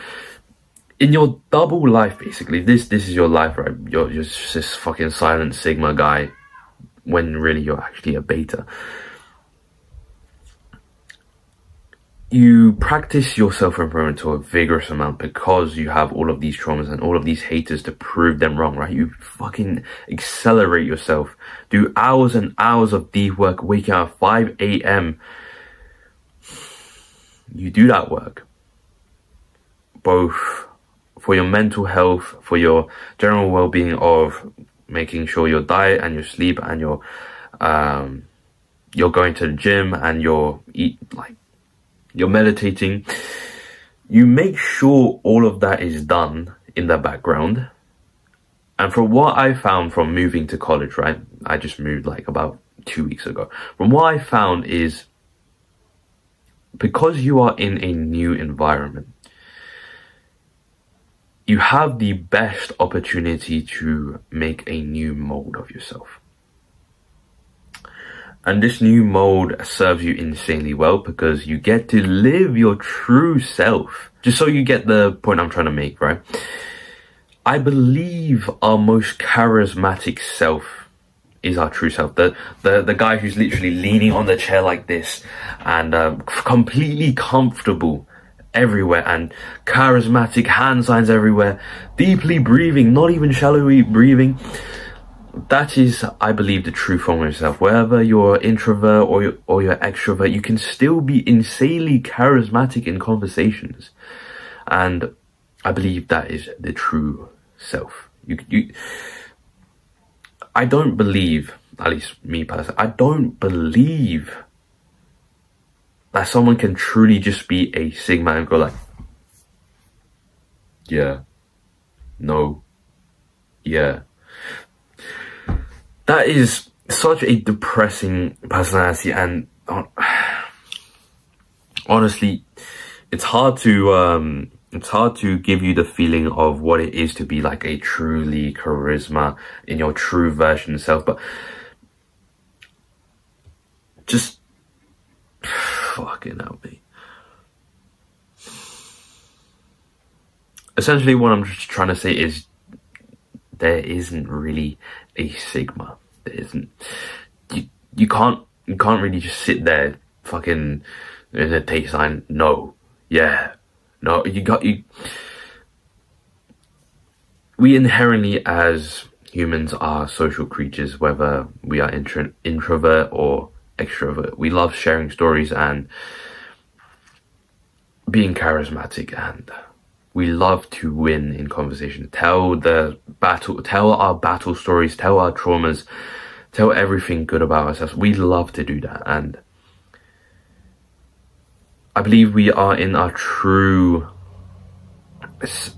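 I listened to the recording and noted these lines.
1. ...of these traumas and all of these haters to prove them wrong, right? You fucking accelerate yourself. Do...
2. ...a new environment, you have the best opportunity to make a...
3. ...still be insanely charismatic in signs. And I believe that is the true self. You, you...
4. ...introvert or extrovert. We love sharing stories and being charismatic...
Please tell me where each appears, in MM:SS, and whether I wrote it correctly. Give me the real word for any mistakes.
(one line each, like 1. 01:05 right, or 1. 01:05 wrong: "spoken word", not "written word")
1. 00:16 right
2. 00:57 right
3. 01:40 wrong: "conversations", not "signs"
4. 02:52 right.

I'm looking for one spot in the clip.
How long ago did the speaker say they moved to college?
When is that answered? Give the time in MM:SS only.
00:52.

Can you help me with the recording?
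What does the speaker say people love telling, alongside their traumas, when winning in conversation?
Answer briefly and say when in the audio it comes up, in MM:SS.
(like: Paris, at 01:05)
battle stories, at 03:04.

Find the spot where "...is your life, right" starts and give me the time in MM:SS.
00:03.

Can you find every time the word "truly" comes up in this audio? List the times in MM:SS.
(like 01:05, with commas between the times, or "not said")
01:56, 02:17.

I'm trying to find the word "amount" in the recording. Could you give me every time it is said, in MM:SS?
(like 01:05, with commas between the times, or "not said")
00:14.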